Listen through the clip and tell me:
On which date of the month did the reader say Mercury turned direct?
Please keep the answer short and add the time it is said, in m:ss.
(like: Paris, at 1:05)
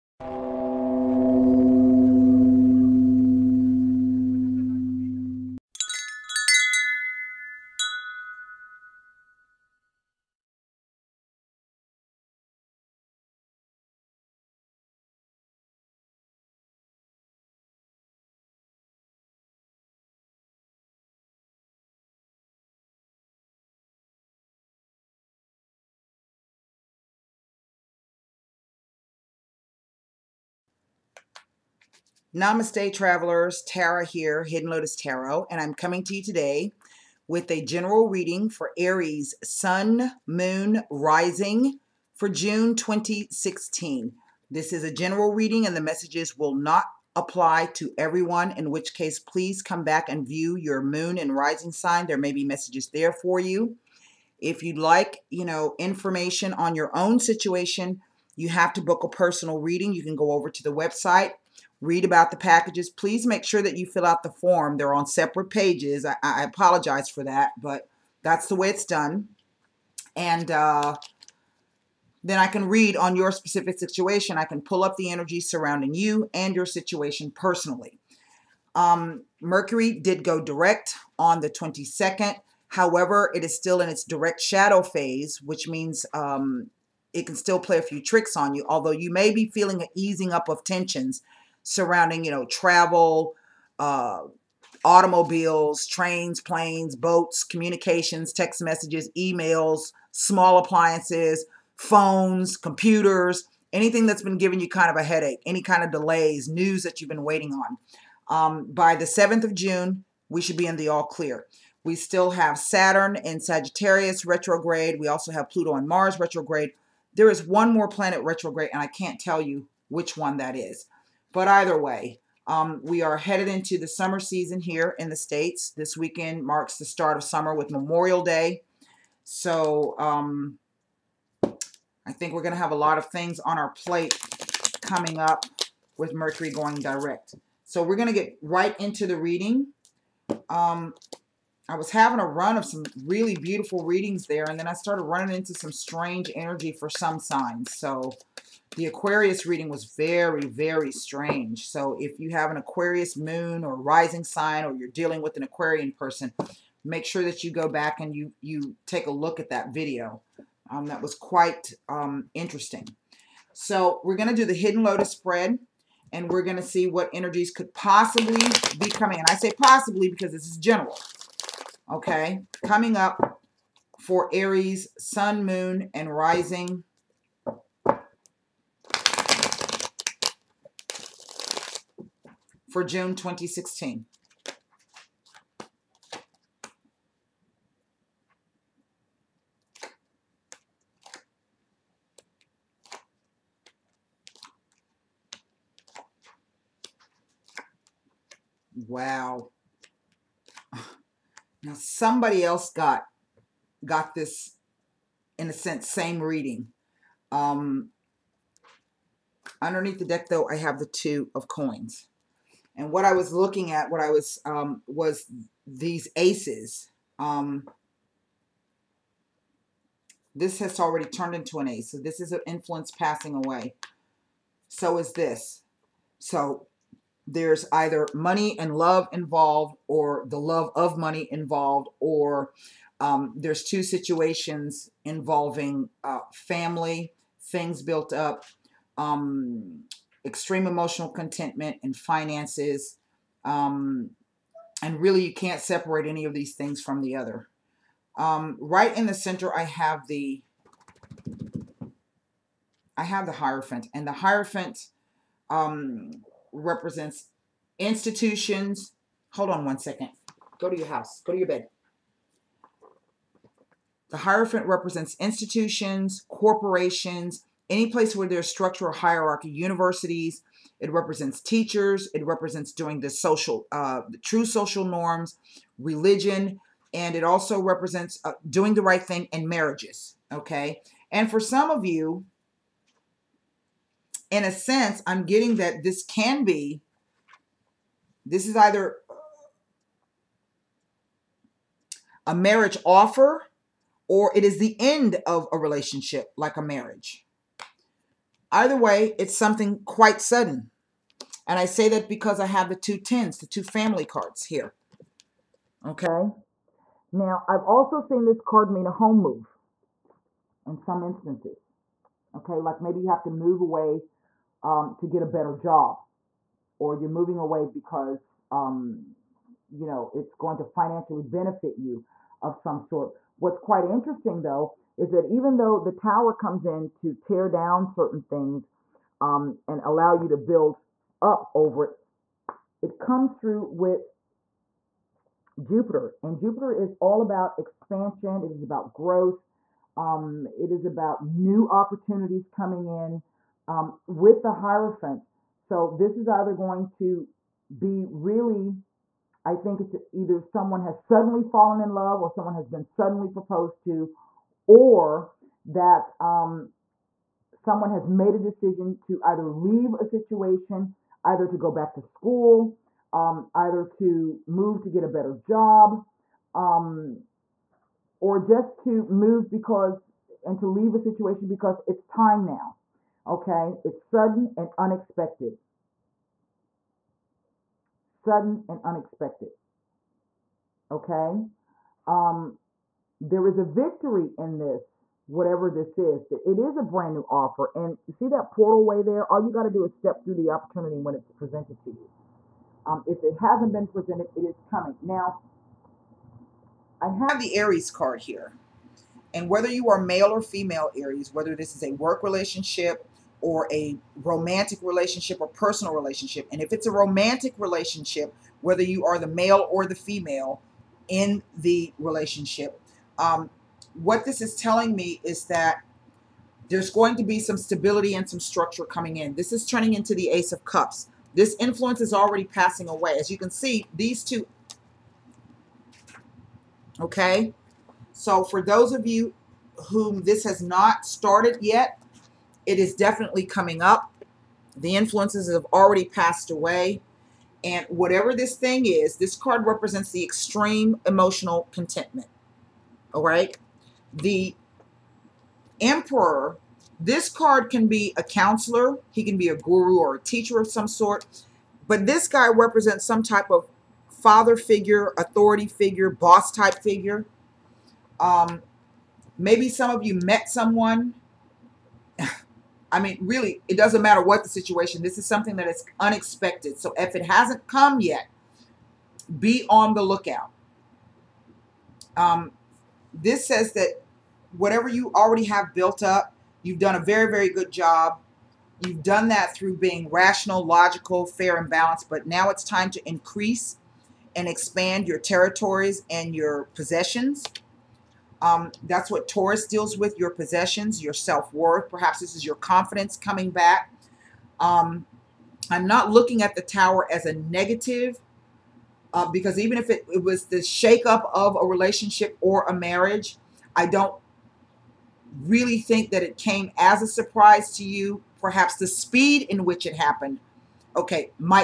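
22nd, at 1:21.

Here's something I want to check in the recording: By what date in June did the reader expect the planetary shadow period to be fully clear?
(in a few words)
7th of June.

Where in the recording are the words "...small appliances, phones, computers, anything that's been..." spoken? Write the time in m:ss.
1:40.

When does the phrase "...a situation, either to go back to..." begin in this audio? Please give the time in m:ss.
5:59.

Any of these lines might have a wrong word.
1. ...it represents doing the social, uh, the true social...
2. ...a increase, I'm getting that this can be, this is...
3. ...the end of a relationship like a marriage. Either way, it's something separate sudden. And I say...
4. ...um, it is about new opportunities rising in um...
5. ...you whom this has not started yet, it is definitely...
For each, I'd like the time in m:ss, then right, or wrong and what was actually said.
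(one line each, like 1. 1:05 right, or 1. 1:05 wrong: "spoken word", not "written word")
1. 4:32 right
2. 4:44 wrong: "sense", not "increase"
3. 4:54 wrong: "quite", not "separate"
4. 5:39 wrong: "coming", not "rising"
5. 7:09 right.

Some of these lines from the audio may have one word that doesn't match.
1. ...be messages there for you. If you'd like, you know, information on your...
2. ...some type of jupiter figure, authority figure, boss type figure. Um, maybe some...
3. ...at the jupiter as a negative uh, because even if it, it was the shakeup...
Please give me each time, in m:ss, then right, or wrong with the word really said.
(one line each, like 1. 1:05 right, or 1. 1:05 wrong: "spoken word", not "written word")
1. 0:52 right
2. 7:33 wrong: "father", not "jupiter"
3. 8:16 wrong: "tower", not "jupiter".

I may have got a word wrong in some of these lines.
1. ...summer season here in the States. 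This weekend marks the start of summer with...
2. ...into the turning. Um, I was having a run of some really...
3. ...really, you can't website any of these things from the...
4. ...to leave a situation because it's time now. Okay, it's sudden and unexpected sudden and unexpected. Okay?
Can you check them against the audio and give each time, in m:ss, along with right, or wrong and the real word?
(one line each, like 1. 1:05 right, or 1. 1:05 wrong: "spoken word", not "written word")
1. 2:03 right
2. 2:18 wrong: "reading", not "turning"
3. 4:05 wrong: "separate", not "website"
4. 6:10 right.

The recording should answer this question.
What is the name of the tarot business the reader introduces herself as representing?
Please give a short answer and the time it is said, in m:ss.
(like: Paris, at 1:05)
Hidden Lotus Tarot, at 0:34.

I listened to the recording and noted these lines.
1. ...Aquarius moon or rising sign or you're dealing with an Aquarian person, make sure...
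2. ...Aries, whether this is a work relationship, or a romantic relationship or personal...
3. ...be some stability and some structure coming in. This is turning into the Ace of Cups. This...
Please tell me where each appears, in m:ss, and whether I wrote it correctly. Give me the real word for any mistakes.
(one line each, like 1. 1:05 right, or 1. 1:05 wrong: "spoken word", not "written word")
1. 2:32 right
2. 6:40 right
3. 6:57 right.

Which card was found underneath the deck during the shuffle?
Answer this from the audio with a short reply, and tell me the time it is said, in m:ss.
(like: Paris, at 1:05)
Two of Coins, at 3:30.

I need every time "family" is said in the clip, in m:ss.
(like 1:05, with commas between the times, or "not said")
3:56, 5:03.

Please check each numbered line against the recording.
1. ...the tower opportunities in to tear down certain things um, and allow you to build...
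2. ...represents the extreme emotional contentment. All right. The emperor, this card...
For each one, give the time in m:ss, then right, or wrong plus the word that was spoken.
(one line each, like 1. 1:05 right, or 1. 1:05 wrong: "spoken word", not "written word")
1. 5:25 wrong: "comes", not "opportunities"
2. 7:19 right.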